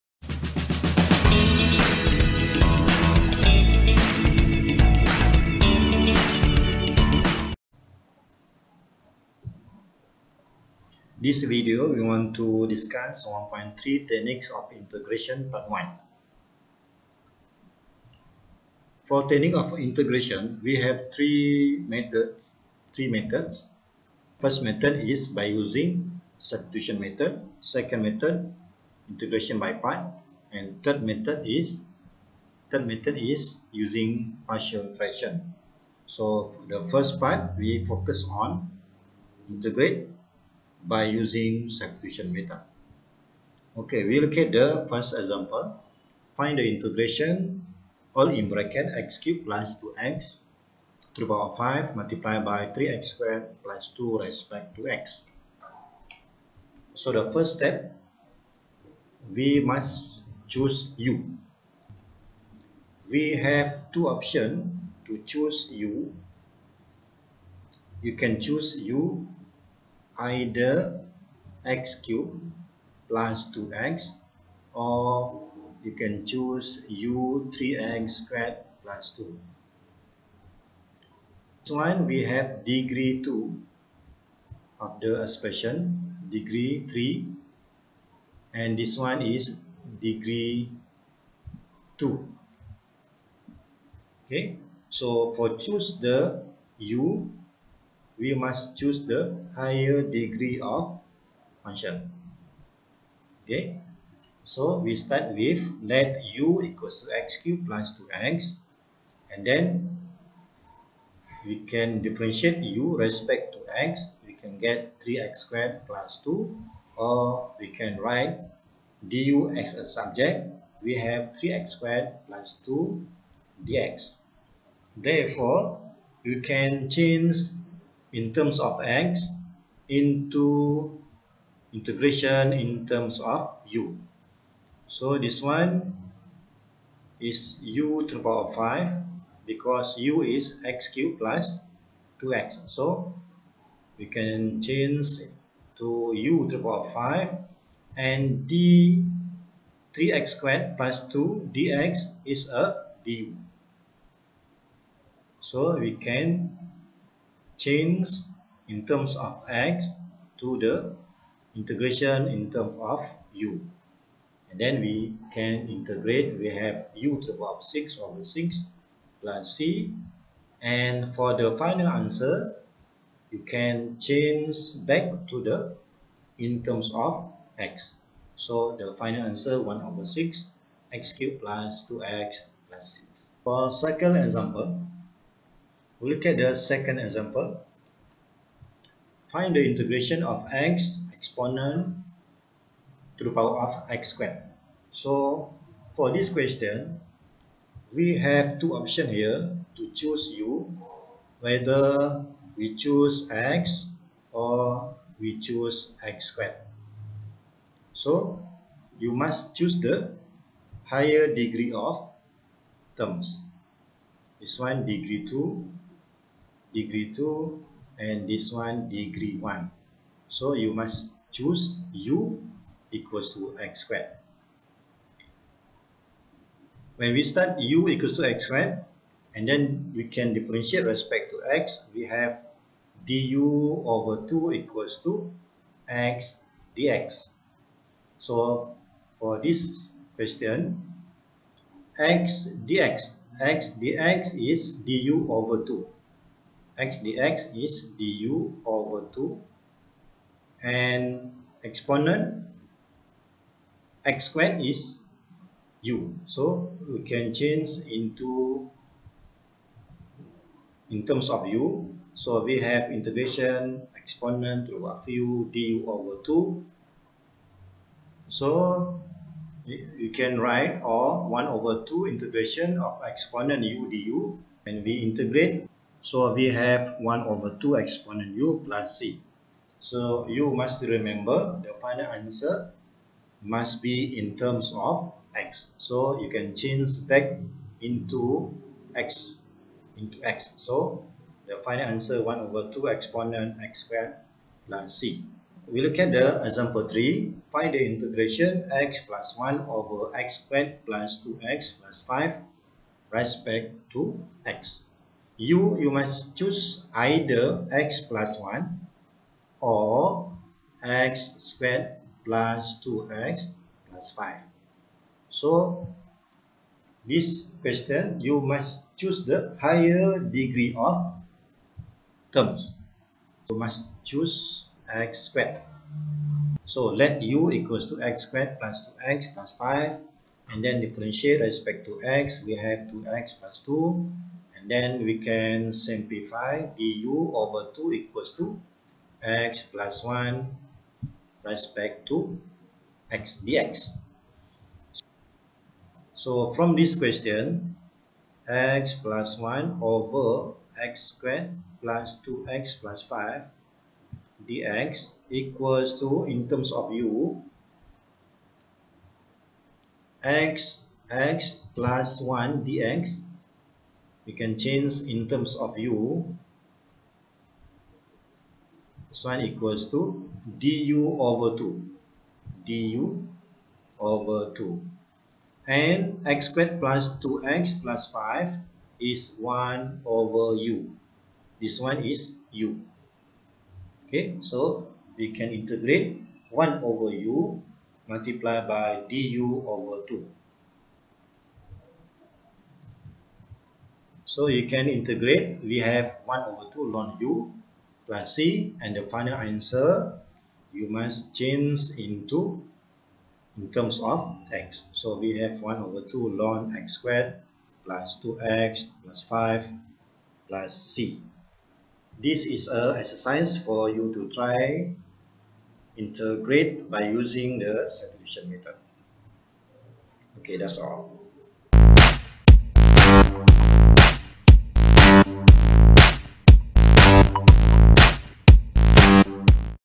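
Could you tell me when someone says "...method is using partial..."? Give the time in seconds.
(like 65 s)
32 s.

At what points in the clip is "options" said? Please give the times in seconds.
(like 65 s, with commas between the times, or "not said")
64 s, 198 s.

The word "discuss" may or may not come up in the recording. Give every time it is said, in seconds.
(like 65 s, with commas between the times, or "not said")
12 s.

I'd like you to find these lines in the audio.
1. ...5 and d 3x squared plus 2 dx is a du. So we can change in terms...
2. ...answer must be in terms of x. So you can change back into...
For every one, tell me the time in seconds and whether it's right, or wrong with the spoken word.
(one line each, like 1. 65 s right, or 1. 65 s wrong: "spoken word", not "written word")
1. 146 s right
2. 282 s right.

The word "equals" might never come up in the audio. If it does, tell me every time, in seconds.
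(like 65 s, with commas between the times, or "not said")
106 s, 222 s, 227 s, 234 s, 327 s, 337 s, 355 s, 369 s.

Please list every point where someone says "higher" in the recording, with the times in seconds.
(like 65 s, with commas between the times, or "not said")
99 s, 210 s, 319 s.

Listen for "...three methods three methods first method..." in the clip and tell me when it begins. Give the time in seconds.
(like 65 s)
21 s.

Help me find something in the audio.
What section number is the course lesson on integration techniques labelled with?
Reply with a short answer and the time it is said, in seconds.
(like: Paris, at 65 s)
1.3, at 13 s.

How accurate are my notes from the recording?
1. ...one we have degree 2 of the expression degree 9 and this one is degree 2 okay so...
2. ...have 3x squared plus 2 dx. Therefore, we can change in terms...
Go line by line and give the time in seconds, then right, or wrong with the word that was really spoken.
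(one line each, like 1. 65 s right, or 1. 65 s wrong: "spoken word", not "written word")
1. 81 s wrong: "3", not "9"
2. 120 s right.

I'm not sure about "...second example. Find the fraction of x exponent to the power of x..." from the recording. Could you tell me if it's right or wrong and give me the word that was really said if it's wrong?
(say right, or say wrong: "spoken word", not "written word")
wrong: "integration", not "fraction".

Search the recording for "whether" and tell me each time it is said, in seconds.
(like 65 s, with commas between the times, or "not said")
201 s.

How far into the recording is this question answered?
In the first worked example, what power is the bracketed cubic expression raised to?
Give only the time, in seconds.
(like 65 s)
51 s.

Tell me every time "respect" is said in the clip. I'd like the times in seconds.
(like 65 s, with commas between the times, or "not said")
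54 s, 112 s, 230 s, 303 s, 331 s, 341 s.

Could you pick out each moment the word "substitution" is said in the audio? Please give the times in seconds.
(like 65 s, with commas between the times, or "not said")
26 s, 41 s, 417 s.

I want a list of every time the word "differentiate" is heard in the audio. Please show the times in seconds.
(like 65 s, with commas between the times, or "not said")
112 s, 230 s, 330 s.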